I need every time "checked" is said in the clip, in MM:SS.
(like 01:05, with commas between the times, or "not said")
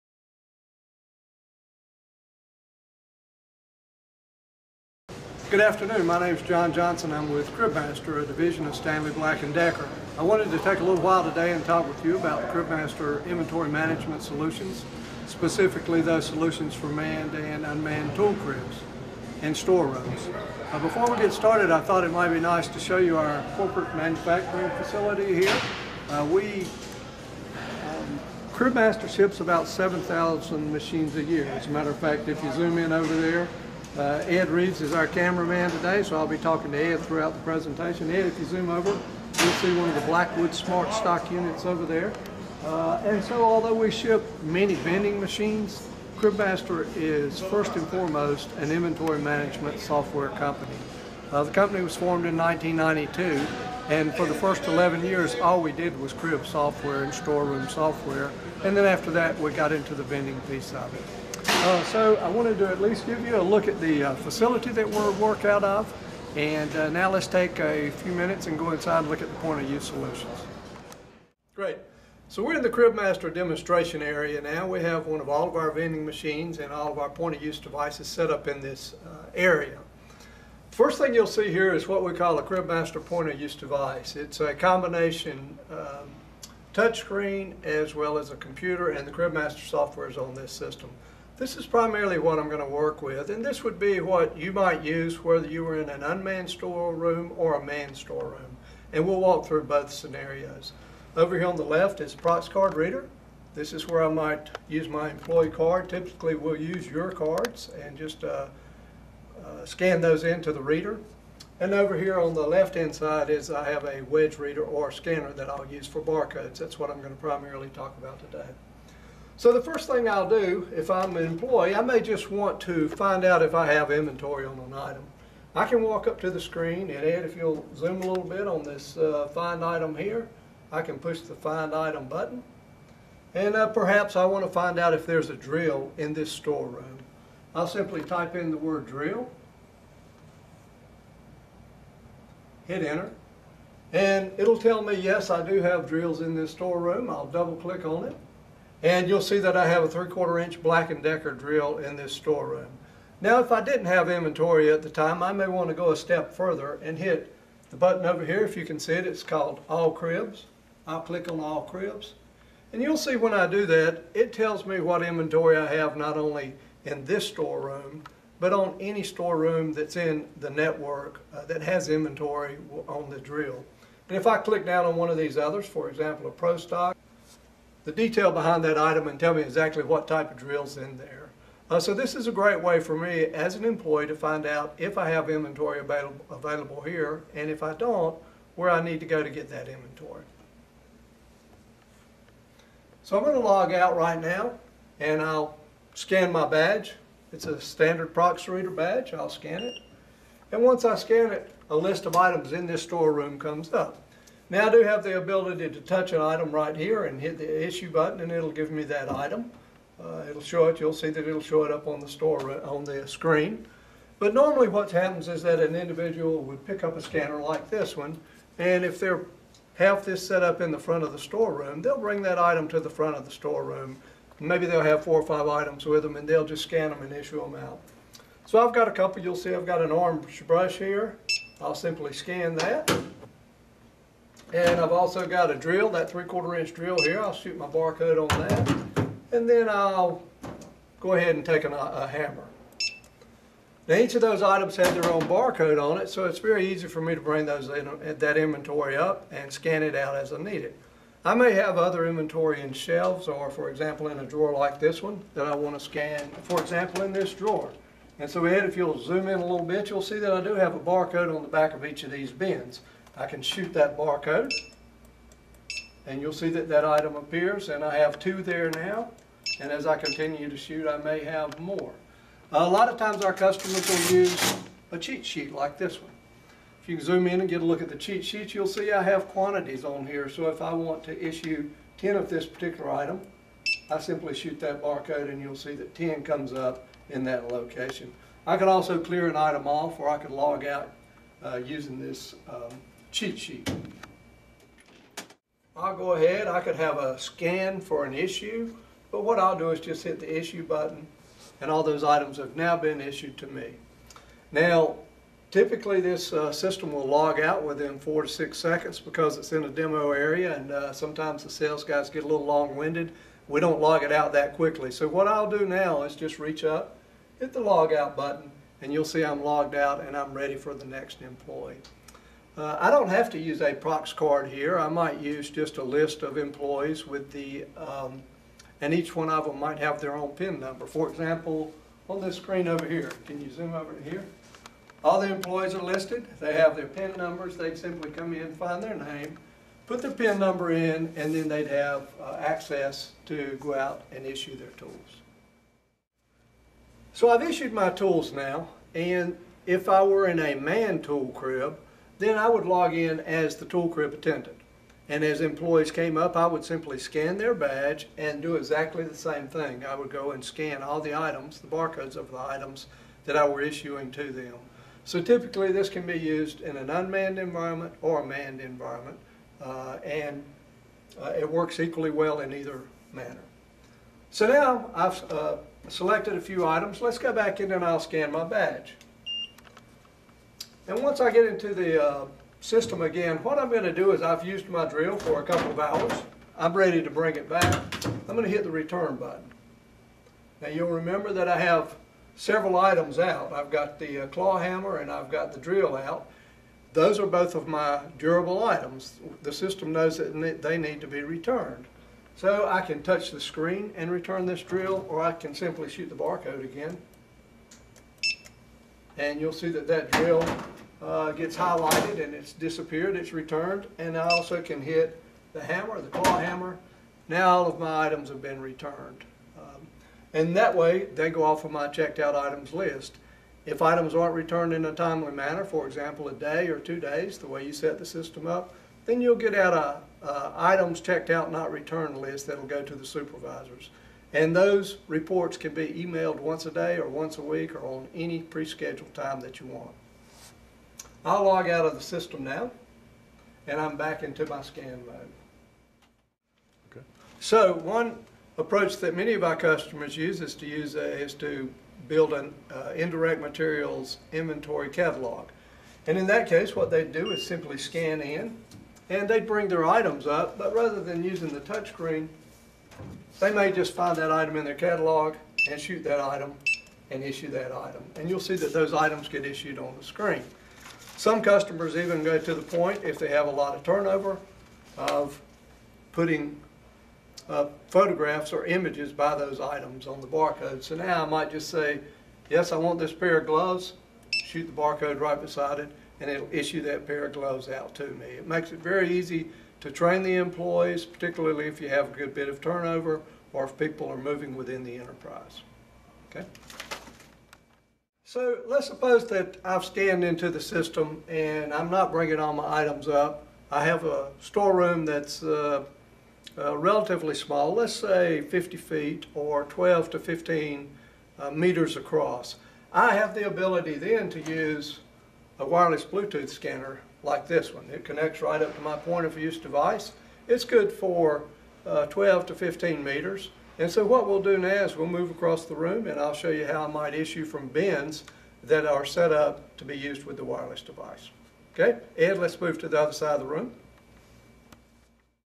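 07:01, 07:10.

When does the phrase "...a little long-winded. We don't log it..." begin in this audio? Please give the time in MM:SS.
05:12.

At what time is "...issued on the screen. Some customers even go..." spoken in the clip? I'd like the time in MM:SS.
07:49.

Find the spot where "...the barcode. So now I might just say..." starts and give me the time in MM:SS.
08:00.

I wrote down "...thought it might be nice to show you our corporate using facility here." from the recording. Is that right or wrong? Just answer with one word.
wrong.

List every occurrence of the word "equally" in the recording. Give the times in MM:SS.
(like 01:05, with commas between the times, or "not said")
06:11.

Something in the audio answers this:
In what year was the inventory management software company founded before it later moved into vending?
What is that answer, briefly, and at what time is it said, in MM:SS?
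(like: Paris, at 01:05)
1992, at 00:52.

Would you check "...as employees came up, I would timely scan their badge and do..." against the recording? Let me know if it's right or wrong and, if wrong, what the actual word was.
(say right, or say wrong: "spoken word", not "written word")
wrong: "simply", not "timely".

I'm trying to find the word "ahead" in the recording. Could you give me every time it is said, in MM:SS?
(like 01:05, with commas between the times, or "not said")
04:01, 04:56.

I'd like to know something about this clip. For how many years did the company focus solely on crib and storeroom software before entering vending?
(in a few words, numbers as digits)
11.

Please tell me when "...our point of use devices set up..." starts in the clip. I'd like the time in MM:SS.
01:16.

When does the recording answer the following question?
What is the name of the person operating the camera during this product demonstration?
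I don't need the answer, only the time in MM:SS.
00:34.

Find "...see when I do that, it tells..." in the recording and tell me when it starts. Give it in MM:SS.
02:42.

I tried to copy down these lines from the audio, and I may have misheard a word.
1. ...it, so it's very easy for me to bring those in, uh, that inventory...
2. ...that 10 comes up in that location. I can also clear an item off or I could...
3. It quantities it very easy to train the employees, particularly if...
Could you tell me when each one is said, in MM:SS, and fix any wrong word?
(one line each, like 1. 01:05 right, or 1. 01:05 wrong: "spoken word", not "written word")
1. 04:05 right
2. 04:45 right
3. 08:08 wrong: "makes", not "quantities".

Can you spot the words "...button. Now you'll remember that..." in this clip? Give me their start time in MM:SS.
06:29.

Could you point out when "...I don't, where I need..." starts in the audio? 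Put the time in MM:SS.
03:07.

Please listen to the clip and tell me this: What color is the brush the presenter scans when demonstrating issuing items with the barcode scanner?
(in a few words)
orange.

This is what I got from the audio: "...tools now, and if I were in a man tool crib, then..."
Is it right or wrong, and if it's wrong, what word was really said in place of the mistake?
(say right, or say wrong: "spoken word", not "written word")
right.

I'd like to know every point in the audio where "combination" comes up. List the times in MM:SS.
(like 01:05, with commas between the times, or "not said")
01:24.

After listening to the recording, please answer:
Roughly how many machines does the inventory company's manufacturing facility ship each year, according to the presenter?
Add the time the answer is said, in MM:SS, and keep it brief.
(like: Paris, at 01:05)
7,000, at 00:29.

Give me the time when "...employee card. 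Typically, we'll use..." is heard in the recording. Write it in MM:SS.
01:45.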